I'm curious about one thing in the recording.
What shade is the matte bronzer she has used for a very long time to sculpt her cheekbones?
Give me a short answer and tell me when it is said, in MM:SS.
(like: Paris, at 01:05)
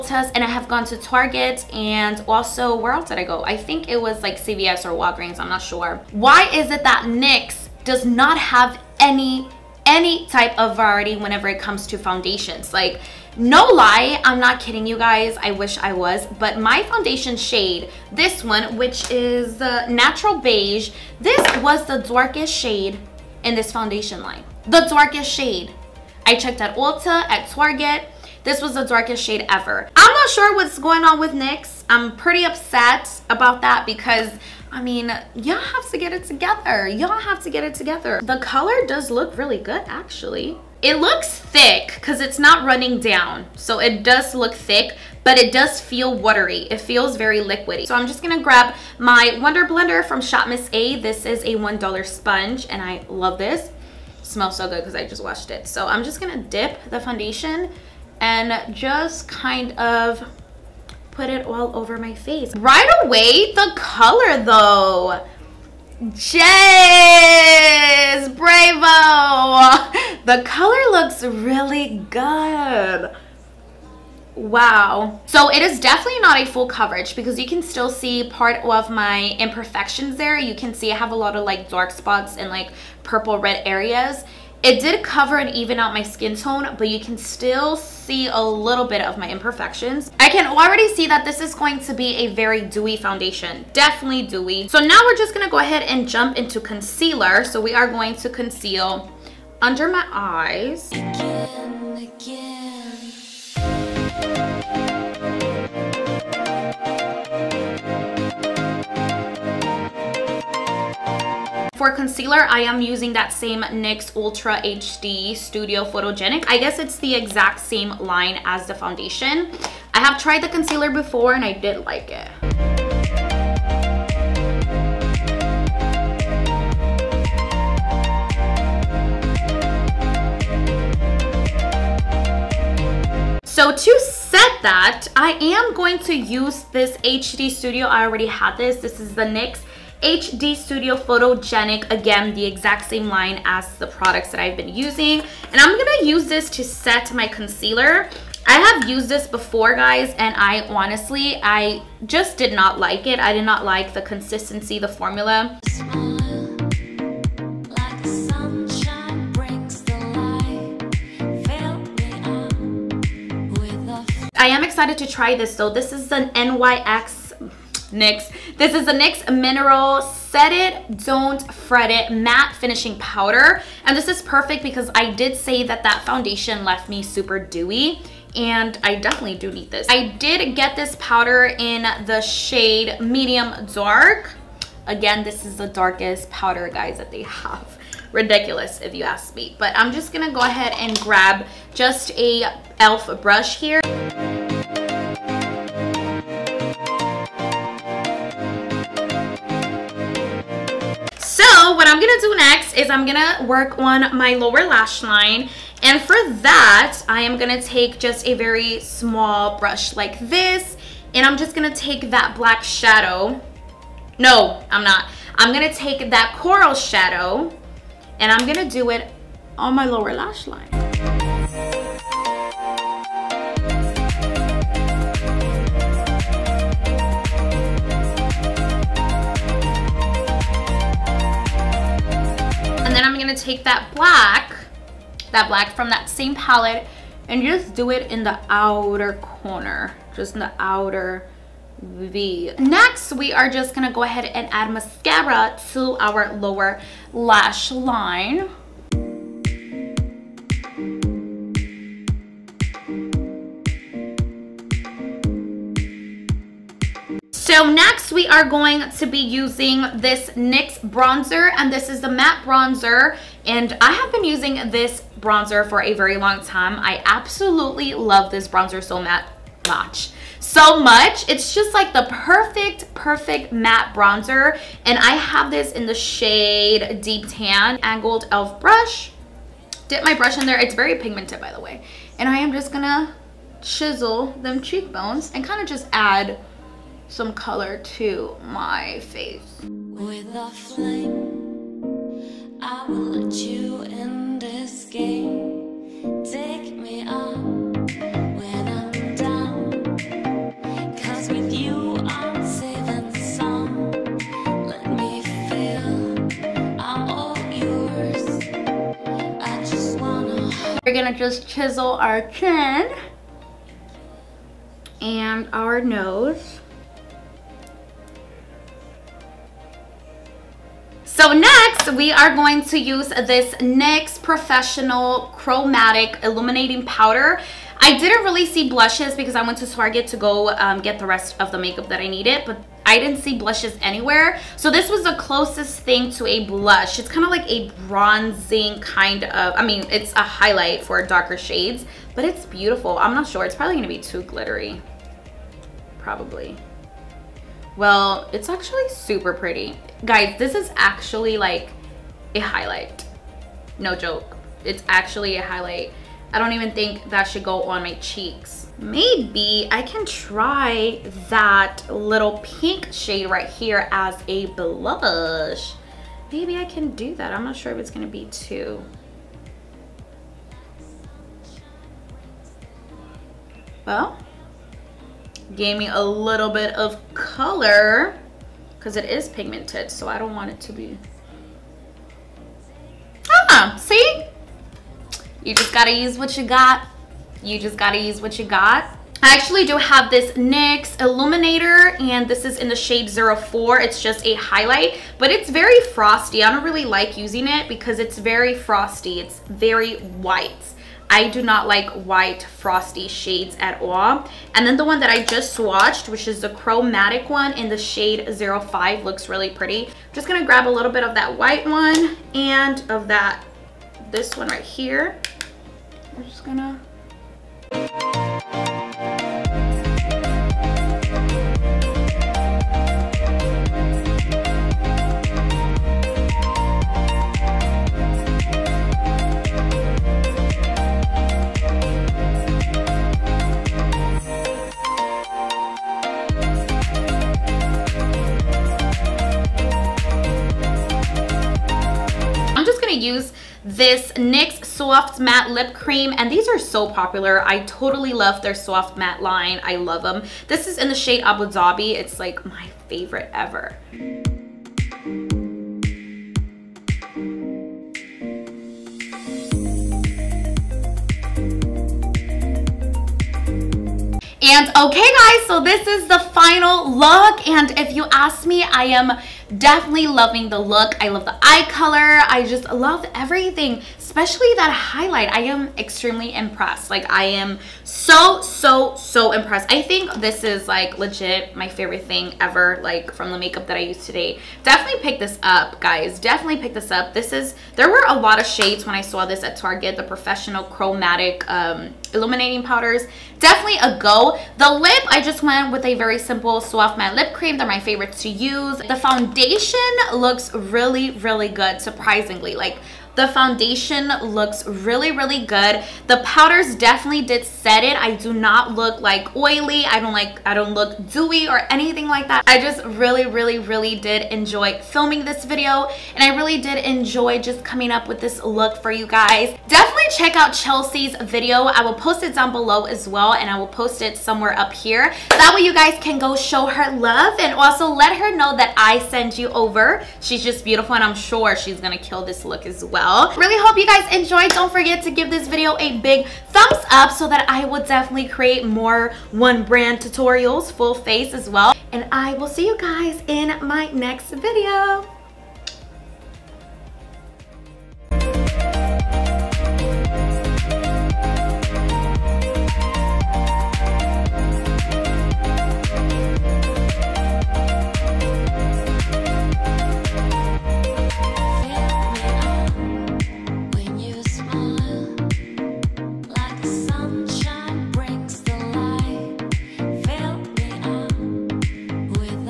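deep tan, at 04:37.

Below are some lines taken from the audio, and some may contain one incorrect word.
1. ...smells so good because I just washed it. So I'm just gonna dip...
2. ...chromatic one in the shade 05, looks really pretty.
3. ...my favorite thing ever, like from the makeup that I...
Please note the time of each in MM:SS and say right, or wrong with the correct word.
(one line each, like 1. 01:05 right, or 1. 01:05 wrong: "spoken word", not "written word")
1. 00:54 right
2. 06:46 right
3. 08:01 right.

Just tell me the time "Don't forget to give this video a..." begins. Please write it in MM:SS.
08:54.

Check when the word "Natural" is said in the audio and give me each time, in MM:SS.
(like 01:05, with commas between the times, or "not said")
00:19.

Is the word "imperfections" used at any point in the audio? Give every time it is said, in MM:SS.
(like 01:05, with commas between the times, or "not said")
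01:19, 01:29.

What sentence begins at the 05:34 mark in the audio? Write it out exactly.
So this was the closest thing to a blush.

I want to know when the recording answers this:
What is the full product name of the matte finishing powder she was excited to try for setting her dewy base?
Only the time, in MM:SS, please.
02:49.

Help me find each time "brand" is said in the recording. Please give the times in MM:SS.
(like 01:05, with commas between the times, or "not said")
08:59.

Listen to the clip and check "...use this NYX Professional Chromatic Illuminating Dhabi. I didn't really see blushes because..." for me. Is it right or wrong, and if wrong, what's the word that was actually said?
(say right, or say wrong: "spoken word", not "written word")
wrong: "Powder", not "Dhabi".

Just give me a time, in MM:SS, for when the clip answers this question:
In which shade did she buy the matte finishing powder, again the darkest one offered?
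03:03.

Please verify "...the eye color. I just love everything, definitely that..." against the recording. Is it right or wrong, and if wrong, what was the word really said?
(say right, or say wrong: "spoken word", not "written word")
wrong: "especially", not "definitely".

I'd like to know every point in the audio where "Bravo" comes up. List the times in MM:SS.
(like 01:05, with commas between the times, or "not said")
01:08.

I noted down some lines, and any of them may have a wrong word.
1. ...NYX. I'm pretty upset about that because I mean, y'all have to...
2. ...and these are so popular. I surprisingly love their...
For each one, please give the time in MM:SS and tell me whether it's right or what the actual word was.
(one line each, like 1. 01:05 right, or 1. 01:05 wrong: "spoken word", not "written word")
1. 00:31 right
2. 07:26 wrong: "totally", not "surprisingly".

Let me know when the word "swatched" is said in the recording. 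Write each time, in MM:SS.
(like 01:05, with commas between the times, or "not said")
06:45.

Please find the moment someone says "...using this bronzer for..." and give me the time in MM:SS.
04:24.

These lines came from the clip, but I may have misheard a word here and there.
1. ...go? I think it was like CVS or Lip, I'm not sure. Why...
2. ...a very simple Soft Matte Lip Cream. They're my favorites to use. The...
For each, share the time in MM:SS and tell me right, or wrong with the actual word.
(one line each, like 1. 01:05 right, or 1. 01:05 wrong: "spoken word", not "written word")
1. 00:03 wrong: "Walgreens", not "Lip"
2. 08:15 right.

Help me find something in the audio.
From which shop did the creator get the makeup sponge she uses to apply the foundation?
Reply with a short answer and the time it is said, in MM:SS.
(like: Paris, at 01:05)
Shop Miss A, at 00:50.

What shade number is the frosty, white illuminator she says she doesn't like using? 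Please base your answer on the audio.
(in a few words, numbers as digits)
04.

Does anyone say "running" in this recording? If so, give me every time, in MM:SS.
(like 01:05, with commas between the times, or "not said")
00:42.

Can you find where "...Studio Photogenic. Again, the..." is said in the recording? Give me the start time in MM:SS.
02:20.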